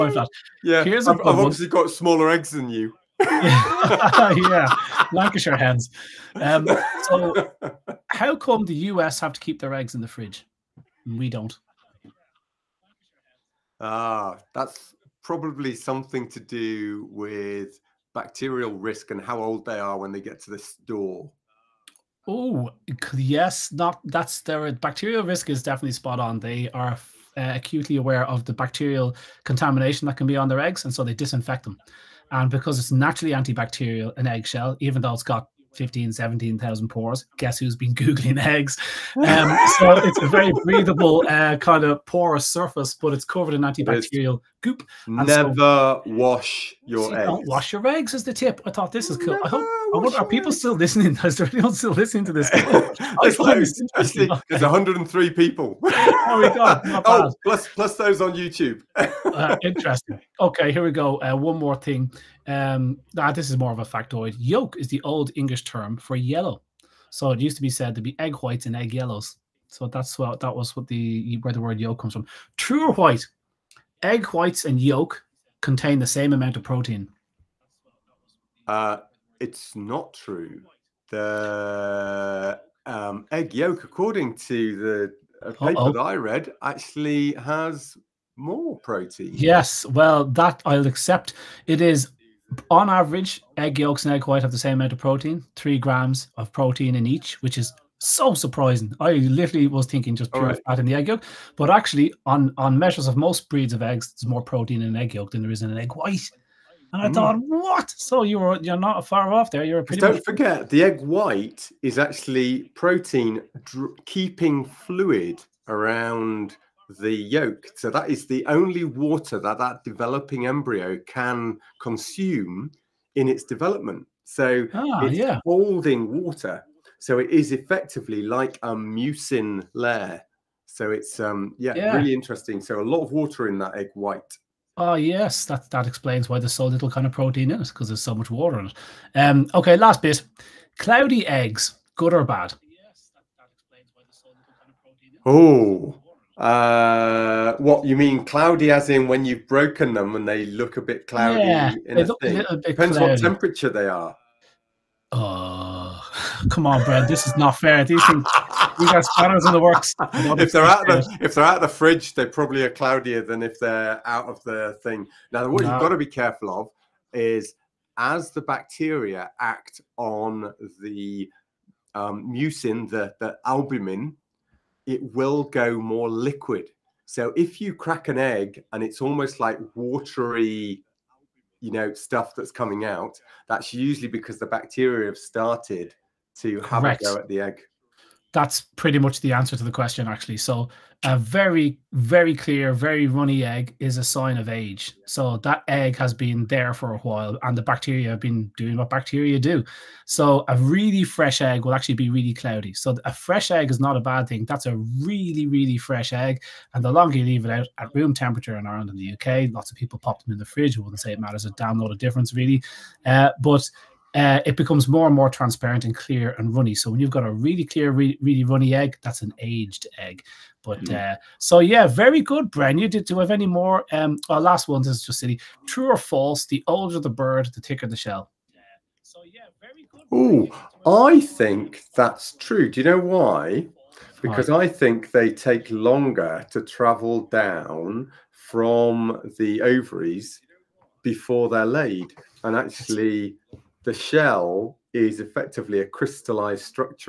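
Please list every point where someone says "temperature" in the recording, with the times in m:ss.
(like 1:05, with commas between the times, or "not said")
2:33, 3:28.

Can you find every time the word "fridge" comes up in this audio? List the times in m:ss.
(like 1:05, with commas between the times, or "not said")
0:10, 2:41, 3:30.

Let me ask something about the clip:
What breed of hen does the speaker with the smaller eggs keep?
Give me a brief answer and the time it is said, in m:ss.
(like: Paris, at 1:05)
Lancashire hens, at 0:05.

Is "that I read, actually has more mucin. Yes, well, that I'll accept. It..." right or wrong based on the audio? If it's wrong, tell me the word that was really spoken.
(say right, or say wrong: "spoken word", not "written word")
wrong: "protein", not "mucin".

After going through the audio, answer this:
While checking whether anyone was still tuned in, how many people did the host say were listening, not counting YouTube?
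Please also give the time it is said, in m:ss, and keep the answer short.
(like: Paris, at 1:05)
103, at 0:54.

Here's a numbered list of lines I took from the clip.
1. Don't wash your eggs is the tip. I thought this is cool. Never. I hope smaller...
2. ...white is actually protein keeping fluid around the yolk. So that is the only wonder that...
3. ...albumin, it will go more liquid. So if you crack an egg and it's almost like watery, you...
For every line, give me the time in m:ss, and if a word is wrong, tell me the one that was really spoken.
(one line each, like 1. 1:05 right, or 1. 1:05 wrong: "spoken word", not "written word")
1. 0:47 wrong: "wonder", not "smaller"
2. 1:50 wrong: "water", not "wonder"
3. 2:53 right.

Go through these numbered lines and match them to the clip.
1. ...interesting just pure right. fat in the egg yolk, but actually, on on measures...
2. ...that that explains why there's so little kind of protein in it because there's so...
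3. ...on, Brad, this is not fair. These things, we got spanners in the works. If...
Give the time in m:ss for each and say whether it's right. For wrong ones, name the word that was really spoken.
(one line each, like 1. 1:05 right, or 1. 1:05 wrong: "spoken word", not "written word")
1. 1:39 wrong: "thinking", not "interesting"
2. 2:15 right
3. 2:36 right.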